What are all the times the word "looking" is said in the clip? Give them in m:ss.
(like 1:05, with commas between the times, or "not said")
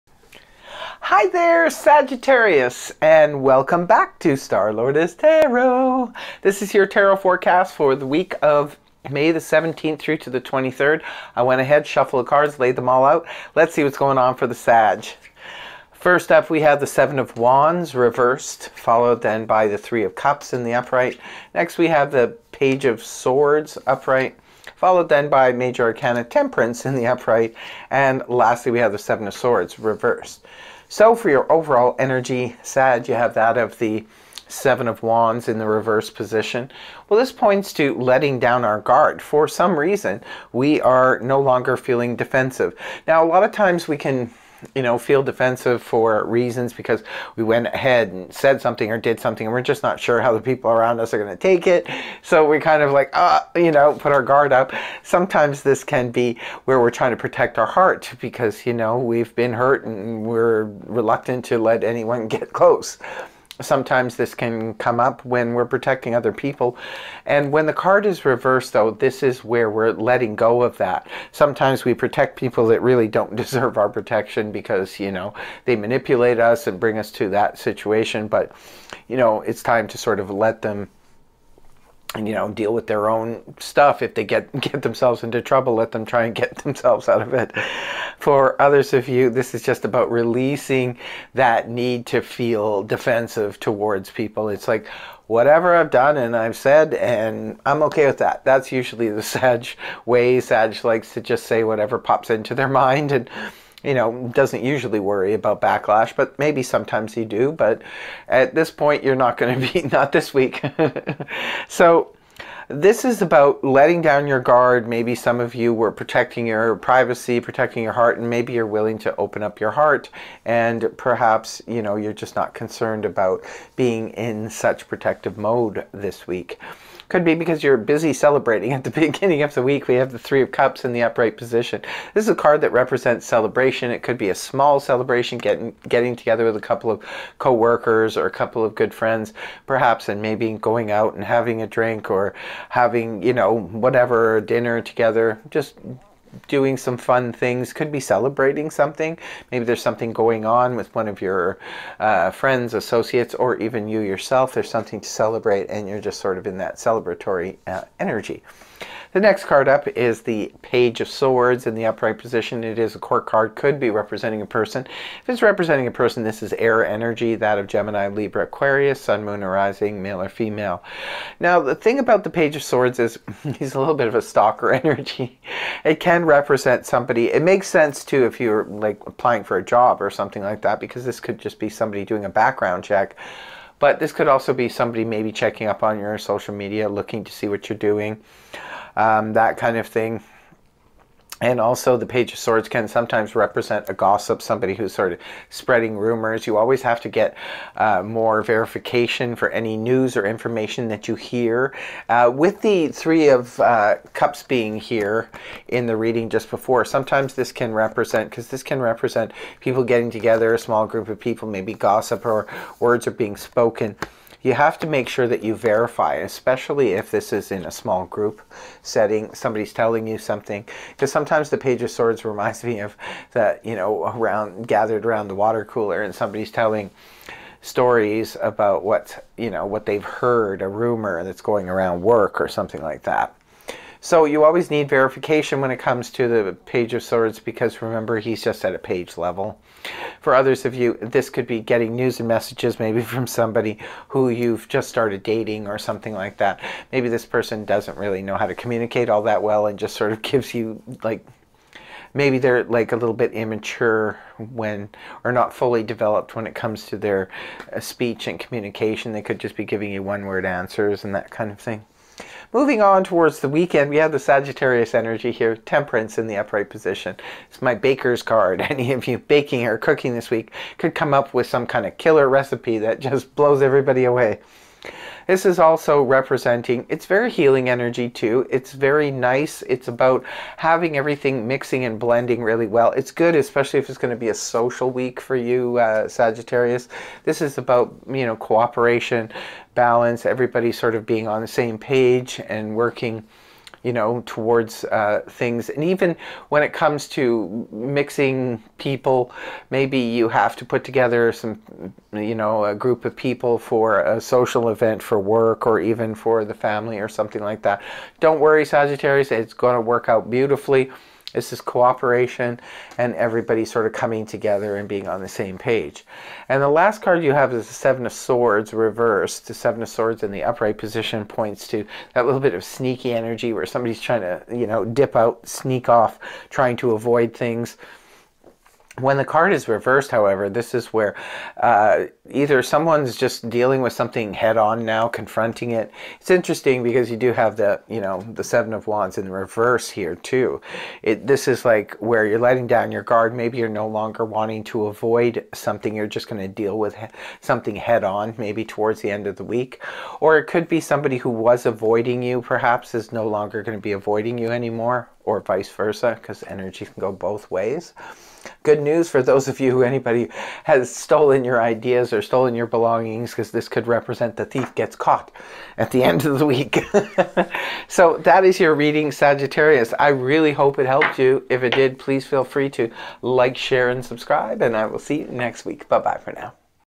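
3:06.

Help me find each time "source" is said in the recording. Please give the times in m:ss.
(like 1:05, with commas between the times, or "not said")
not said.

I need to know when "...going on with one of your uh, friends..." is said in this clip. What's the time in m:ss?
2:30.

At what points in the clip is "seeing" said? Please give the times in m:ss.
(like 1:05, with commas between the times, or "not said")
not said.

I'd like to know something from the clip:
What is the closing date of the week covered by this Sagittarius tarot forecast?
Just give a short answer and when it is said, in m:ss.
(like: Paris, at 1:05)
May 23, at 0:10.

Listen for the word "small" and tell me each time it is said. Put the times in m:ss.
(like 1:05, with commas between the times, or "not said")
2:14, 3:30, 3:37.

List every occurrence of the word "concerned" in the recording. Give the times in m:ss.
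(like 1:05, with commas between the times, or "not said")
2:02.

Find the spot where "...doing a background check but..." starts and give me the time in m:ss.
3:02.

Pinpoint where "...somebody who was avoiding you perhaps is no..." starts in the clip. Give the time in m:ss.
5:50.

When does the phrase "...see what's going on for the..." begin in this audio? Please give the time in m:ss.
0:13.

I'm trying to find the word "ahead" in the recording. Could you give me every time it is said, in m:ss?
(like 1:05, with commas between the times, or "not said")
0:11, 0:47.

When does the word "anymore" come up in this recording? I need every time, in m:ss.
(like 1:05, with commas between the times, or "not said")
5:54.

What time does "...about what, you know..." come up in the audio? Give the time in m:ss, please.
3:48.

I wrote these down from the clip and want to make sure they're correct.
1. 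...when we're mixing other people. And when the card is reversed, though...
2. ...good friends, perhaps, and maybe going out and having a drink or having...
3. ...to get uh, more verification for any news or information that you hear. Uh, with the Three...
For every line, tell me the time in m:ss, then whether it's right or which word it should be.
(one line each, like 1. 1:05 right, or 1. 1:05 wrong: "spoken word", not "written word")
1. 1:05 wrong: "protecting", not "mixing"
2. 2:18 right
3. 3:17 right.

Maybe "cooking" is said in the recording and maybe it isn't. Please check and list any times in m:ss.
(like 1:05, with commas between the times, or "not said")
4:29.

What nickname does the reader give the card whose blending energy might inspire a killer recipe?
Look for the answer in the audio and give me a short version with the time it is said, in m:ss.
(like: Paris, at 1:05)
my baker's card, at 4:27.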